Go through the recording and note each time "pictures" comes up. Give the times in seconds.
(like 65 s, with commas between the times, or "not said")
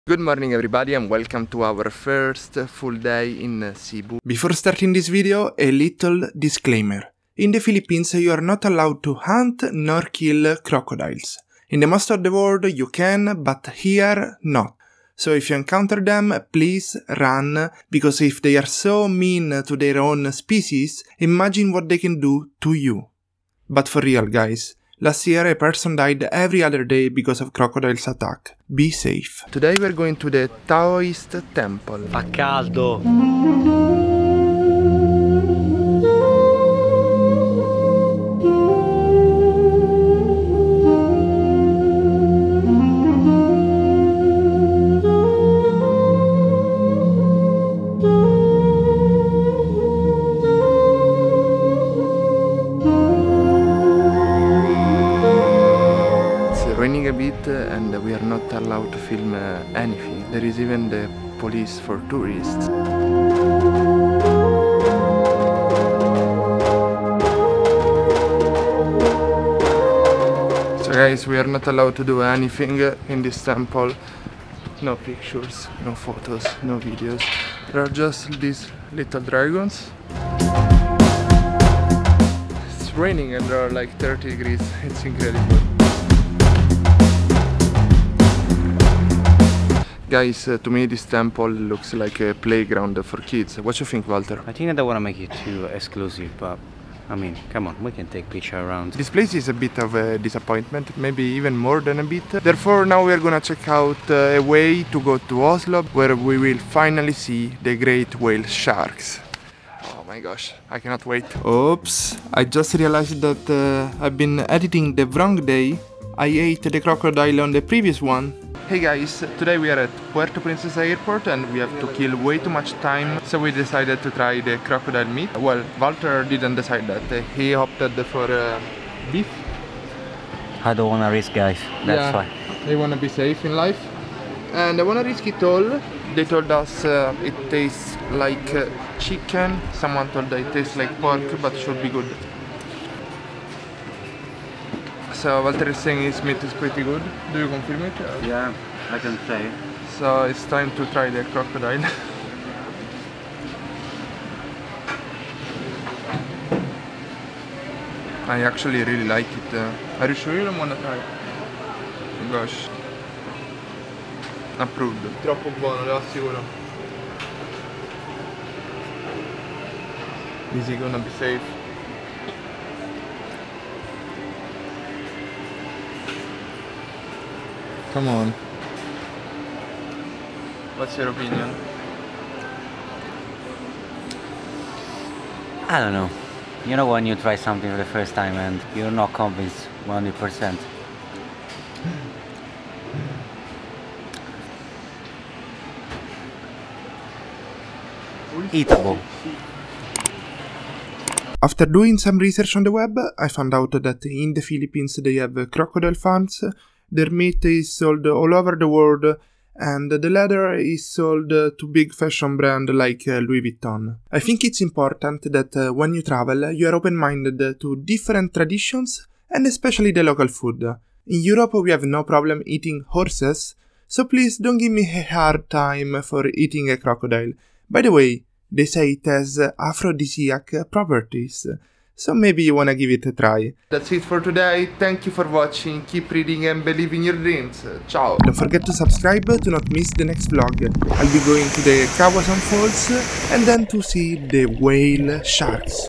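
74 s, 98 s.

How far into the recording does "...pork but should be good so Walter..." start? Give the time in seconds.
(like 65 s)
141 s.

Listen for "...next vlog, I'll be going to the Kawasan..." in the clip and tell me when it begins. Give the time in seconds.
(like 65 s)
240 s.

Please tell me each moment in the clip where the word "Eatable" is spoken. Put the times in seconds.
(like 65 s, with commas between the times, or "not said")
198 s.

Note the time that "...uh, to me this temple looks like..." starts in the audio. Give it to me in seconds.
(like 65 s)
90 s.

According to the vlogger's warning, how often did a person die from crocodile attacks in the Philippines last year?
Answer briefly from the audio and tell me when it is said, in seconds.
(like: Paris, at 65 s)
every other day, at 26 s.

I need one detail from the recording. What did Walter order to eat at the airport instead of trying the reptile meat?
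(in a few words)
beef.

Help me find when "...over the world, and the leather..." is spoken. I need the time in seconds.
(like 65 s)
208 s.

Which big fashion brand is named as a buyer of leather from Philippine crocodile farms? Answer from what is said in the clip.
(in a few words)
Louis Vuitton.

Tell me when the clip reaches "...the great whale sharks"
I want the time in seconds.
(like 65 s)
107 s.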